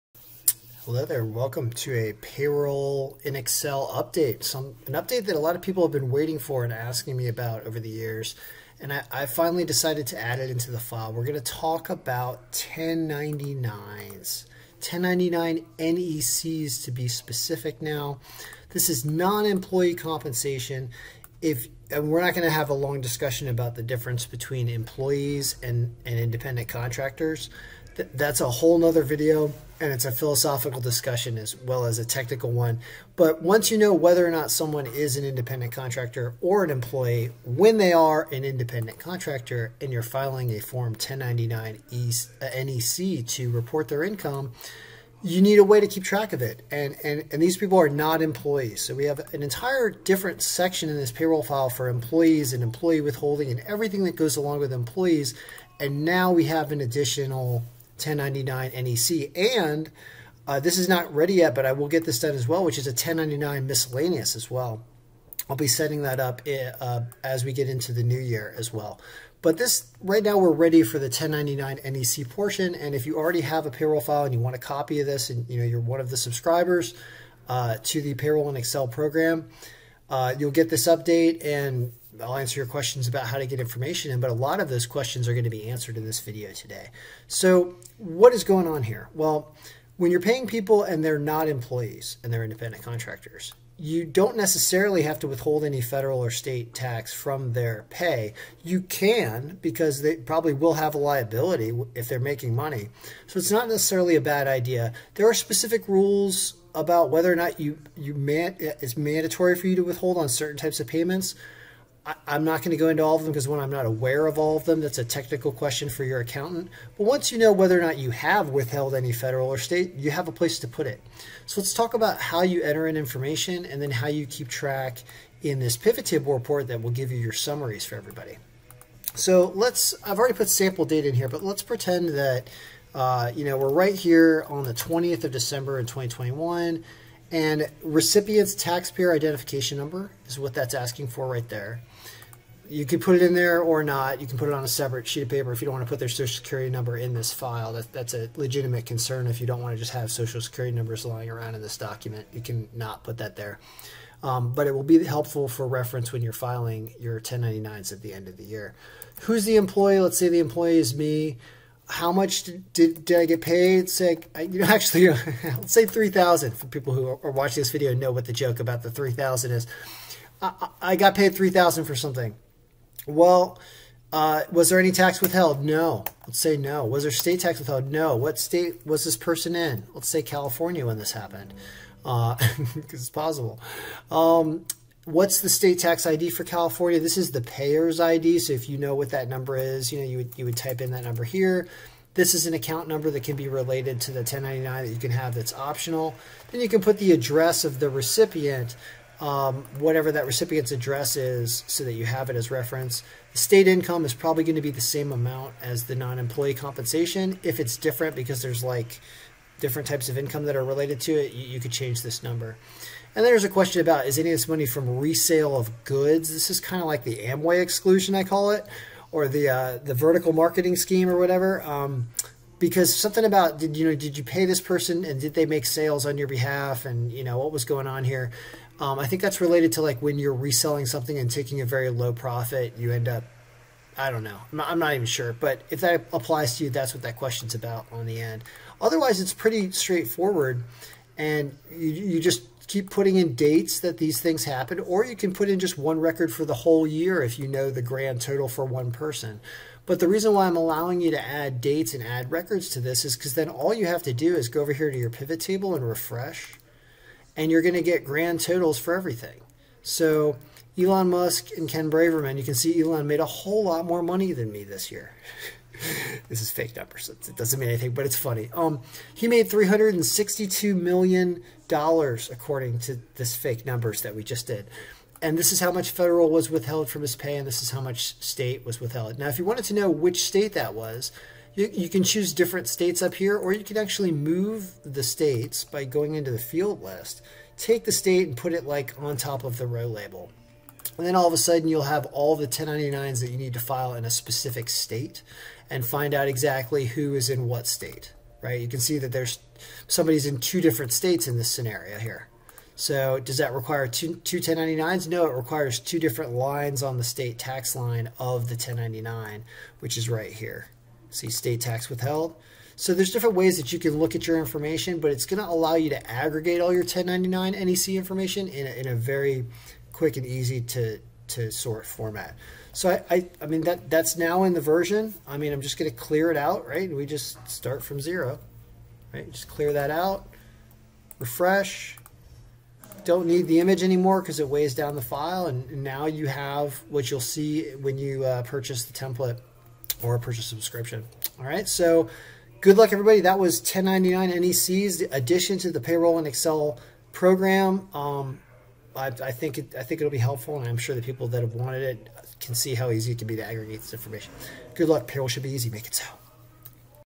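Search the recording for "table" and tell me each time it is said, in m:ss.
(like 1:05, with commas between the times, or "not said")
2:06, 4:15.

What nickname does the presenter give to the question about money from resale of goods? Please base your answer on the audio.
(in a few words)
Amway exclusion.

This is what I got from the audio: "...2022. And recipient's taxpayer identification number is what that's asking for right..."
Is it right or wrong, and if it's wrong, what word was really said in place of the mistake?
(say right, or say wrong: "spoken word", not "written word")
wrong: "2021", not "2022".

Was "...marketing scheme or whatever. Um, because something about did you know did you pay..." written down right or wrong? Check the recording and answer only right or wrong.
right.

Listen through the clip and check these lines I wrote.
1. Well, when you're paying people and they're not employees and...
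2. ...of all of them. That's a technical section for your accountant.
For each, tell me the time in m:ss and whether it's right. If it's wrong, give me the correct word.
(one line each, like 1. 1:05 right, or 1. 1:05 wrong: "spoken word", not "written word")
1. 1:29 right
2. 1:54 wrong: "question", not "section".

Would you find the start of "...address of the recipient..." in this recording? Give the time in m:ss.
3:17.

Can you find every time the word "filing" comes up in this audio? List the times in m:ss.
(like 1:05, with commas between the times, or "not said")
0:40, 2:36.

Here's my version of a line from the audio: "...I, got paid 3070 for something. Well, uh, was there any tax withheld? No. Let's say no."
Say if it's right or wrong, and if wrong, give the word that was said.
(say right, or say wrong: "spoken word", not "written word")
wrong: "3000", not "3070".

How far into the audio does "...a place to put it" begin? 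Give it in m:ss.
2:00.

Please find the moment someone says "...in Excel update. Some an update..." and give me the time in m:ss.
0:03.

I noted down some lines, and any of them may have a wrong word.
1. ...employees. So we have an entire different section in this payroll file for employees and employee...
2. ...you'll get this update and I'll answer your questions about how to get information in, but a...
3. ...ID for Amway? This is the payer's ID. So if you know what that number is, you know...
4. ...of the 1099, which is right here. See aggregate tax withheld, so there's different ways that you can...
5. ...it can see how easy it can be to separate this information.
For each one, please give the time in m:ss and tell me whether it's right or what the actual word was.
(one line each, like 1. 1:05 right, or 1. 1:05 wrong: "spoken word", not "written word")
1. 0:48 right
2. 1:20 right
3. 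3:06 wrong: "California", not "Amway"
4. 5:08 wrong: "state", not "aggregate"
5. 5:51 wrong: "aggregate", not "separate".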